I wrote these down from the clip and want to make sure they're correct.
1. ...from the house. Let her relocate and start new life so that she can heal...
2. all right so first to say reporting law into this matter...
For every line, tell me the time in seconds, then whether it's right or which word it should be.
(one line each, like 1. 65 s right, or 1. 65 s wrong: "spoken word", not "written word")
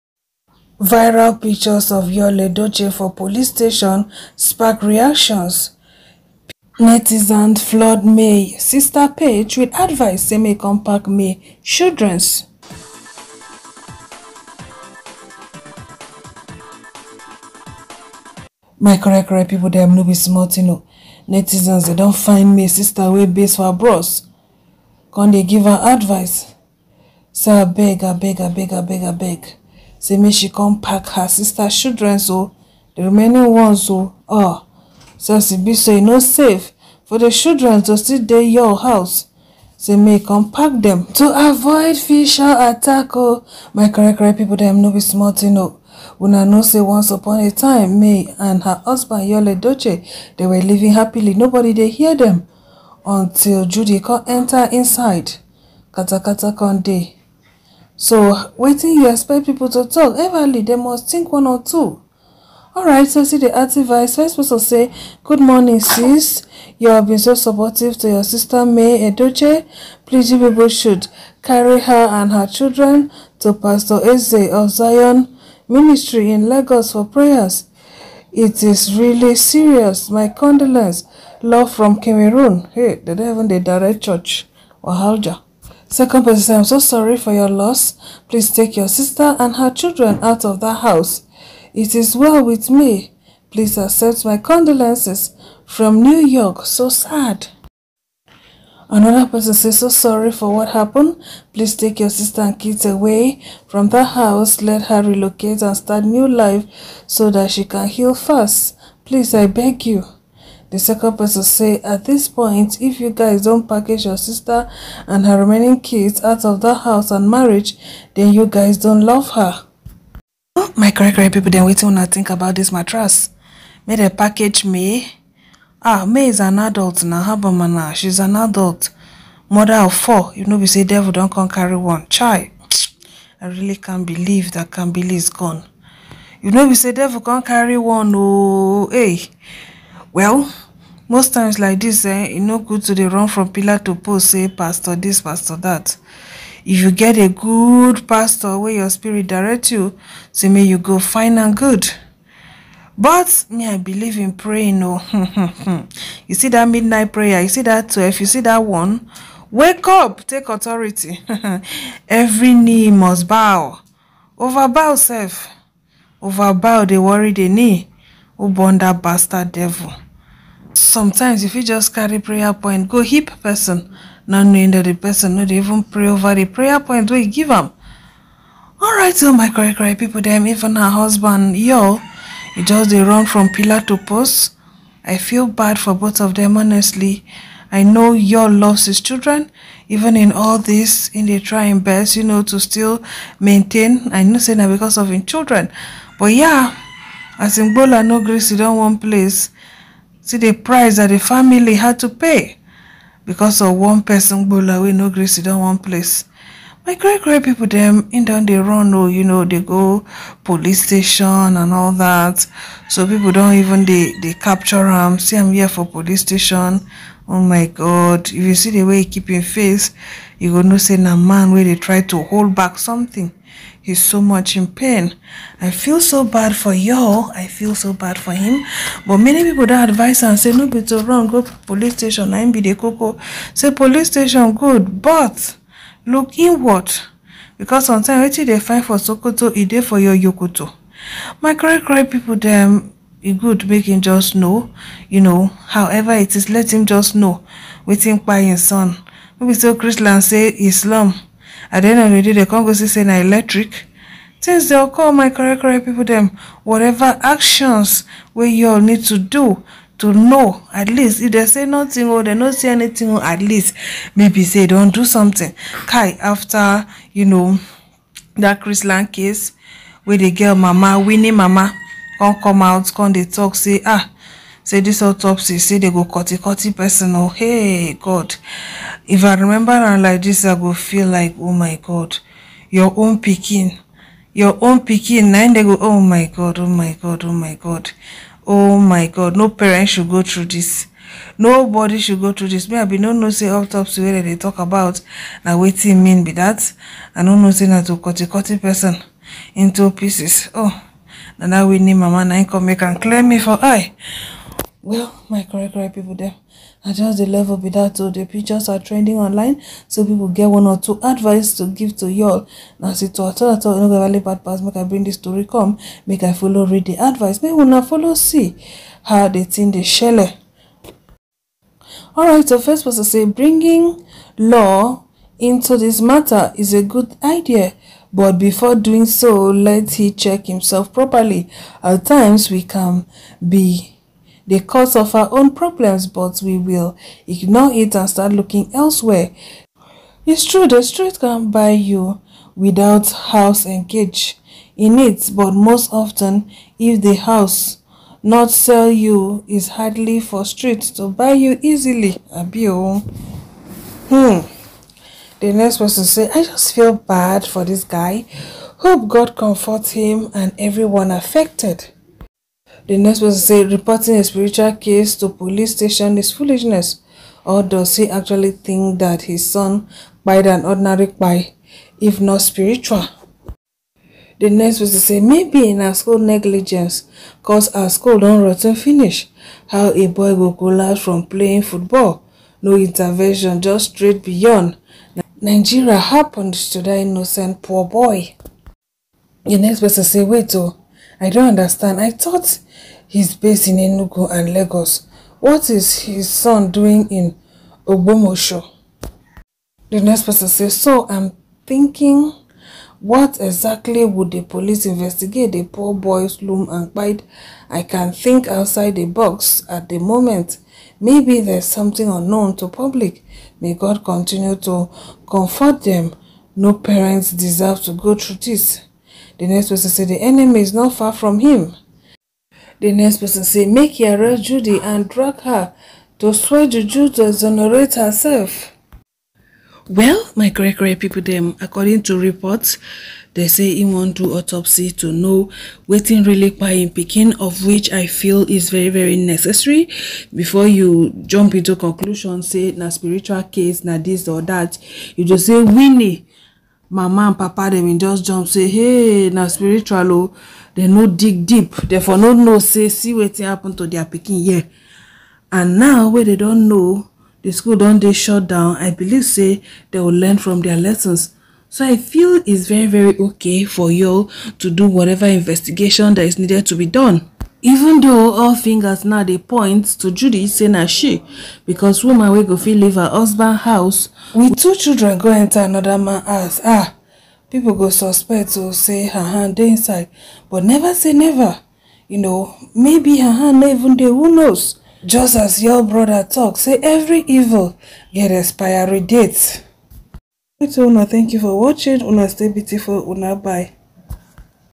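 1. 103 s right
2. 322 s wrong: "bringing", not "reporting".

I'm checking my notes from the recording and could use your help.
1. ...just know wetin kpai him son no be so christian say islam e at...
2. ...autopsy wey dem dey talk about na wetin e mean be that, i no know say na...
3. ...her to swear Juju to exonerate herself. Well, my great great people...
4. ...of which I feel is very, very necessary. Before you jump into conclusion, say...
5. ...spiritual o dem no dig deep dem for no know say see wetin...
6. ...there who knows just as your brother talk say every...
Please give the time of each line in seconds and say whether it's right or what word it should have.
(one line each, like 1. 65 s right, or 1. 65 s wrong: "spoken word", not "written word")
1. 246 s right
2. 293 s right
3. 425 s right
4. 437 s right
5. 449 s right
6. 483 s right.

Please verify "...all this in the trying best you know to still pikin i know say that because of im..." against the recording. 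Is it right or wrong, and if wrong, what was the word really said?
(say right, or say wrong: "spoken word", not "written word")
wrong: "maintain", not "pikin".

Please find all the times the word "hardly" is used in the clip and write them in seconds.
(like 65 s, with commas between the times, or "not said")
349 s.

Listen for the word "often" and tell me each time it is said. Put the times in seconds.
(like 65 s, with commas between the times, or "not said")
345 s.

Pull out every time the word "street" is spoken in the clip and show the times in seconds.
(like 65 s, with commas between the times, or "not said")
340 s, 350 s.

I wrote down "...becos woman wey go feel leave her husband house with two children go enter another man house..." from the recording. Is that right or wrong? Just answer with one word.
right.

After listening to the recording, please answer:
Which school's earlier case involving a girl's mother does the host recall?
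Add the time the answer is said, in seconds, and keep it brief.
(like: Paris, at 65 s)
Chrisland, at 268 s.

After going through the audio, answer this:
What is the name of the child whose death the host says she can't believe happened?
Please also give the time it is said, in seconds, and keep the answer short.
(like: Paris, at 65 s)
Kambili, at 134 s.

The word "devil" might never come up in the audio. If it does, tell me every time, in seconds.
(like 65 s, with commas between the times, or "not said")
130 s, 136 s, 169 s.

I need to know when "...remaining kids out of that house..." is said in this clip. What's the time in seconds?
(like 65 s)
115 s.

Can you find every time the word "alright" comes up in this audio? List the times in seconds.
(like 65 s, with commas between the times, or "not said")
62 s, 178 s.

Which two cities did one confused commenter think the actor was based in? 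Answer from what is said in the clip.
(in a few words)
Enugu and Lagos.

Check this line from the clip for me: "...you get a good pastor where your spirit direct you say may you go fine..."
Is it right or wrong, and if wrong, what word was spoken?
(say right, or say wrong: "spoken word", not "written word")
right.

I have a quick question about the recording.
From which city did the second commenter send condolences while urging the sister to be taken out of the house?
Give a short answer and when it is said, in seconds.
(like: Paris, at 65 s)
New York, at 96 s.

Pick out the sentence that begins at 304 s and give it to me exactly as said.
well my correct right people there.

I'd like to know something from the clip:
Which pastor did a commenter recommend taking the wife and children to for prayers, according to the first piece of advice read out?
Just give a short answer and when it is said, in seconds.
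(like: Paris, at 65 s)
Pastor Eze, at 73 s.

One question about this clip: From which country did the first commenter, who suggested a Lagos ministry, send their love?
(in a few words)
Cameroon.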